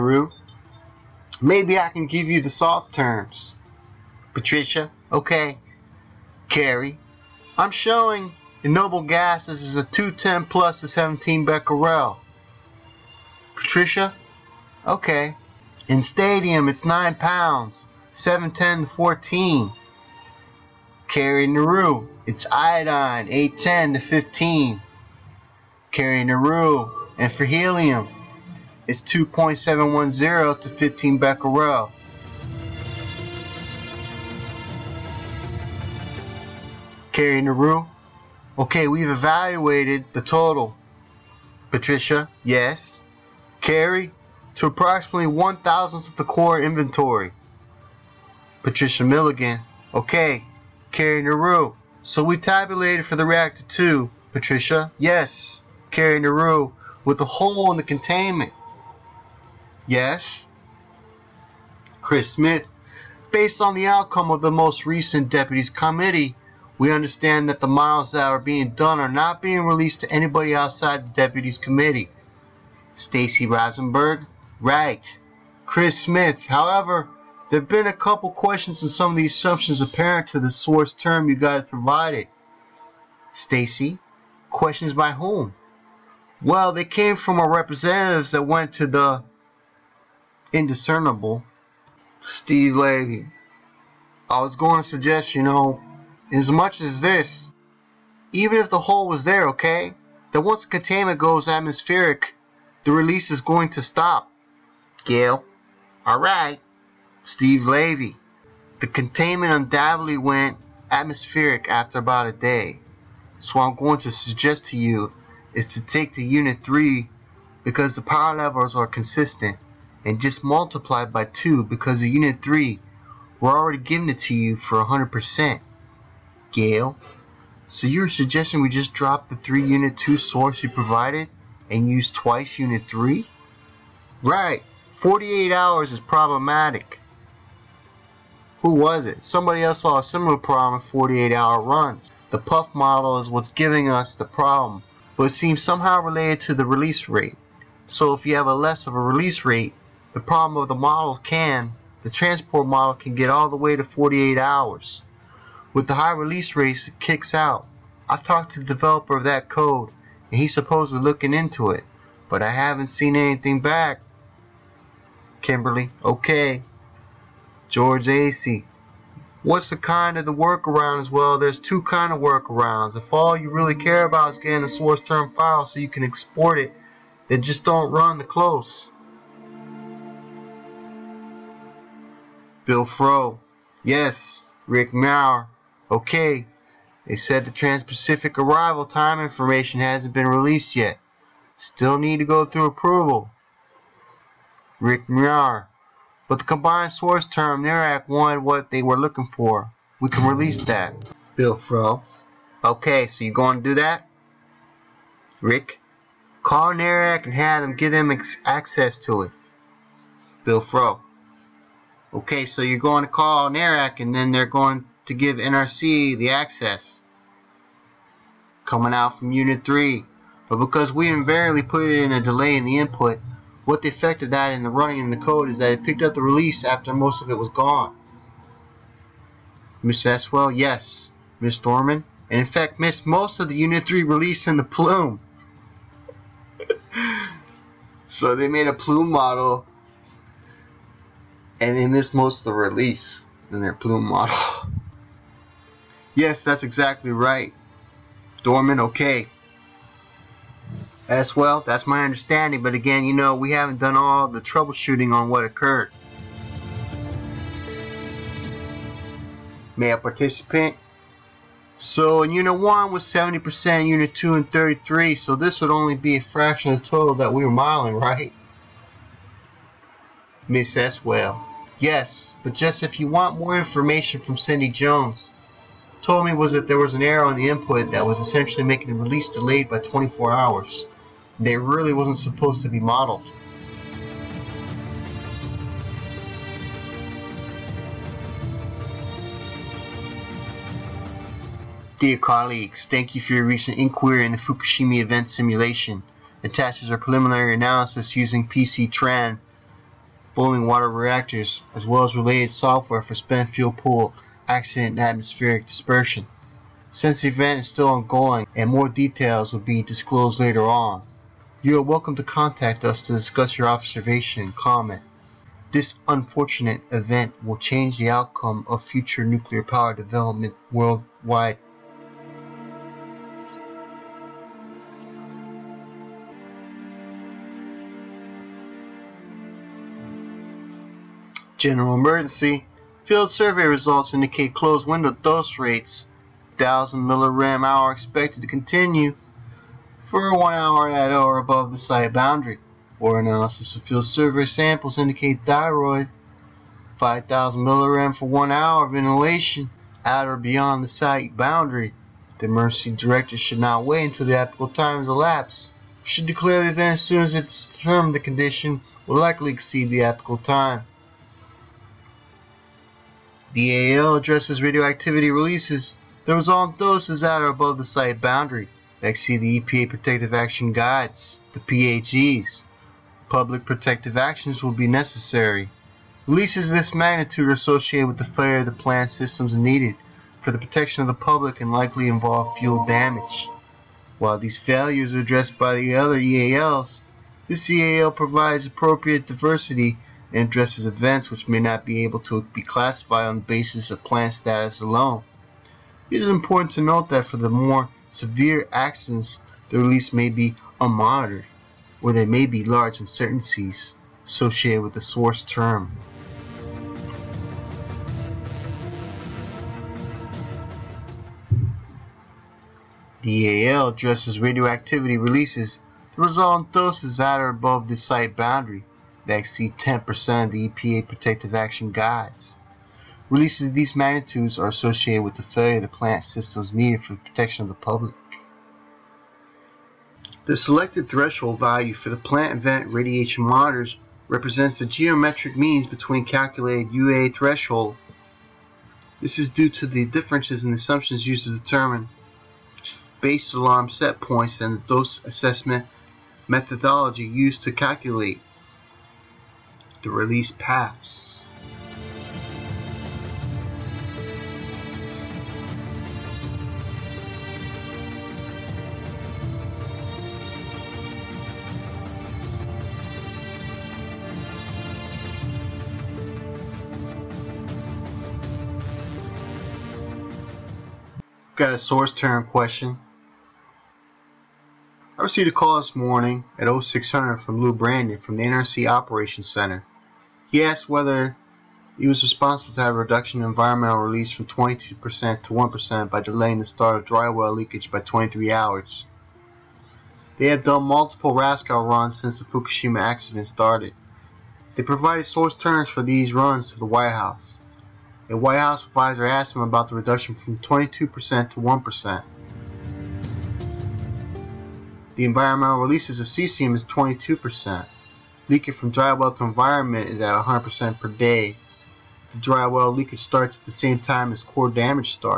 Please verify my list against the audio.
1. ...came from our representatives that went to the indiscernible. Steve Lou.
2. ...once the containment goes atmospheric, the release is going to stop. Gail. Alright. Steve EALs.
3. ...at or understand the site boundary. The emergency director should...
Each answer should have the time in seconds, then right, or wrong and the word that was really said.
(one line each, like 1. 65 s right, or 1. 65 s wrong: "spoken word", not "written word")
1. 86 s wrong: "Levy", not "Lou"
2. 100 s wrong: "Levy", not "EALs"
3. 350 s wrong: "beyond", not "understand".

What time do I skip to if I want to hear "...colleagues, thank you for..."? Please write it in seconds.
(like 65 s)
292 s.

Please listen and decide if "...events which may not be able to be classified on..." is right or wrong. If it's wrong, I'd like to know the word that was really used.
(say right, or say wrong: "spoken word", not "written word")
right.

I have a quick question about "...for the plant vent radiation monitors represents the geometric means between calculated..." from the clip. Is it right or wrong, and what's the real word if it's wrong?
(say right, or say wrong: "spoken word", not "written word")
right.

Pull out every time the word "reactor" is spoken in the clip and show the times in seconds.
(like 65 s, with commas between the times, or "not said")
53 s, 300 s.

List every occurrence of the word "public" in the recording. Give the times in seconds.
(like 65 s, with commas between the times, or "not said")
373 s, 381 s, 427 s.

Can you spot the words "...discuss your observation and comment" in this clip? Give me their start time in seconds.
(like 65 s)
313 s.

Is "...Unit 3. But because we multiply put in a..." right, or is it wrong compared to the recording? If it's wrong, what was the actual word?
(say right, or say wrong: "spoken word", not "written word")
wrong: "invariably", not "multiply".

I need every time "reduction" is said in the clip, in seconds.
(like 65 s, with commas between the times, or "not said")
482 s, 499 s.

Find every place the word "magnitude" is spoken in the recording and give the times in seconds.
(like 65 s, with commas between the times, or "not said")
376 s, 423 s.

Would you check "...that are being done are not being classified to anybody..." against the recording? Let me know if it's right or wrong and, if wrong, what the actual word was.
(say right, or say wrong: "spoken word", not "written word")
wrong: "released", not "classified".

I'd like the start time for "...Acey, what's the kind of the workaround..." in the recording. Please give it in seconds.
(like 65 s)
168 s.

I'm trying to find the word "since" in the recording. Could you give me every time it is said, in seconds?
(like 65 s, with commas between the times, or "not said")
306 s, 492 s.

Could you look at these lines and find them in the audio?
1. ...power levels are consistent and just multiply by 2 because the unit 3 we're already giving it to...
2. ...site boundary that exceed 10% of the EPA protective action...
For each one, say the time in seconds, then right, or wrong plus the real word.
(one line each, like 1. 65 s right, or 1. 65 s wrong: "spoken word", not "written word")
1. 118 s right
2. 417 s right.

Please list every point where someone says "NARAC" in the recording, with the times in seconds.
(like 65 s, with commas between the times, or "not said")
197 s, 206 s, 213 s.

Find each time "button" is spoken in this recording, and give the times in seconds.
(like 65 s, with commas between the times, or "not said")
not said.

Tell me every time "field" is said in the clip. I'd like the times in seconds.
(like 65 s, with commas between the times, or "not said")
333 s, 343 s.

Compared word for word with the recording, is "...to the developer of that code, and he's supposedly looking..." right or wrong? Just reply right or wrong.
right.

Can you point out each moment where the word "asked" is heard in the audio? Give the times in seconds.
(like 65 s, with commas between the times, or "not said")
480 s, 499 s.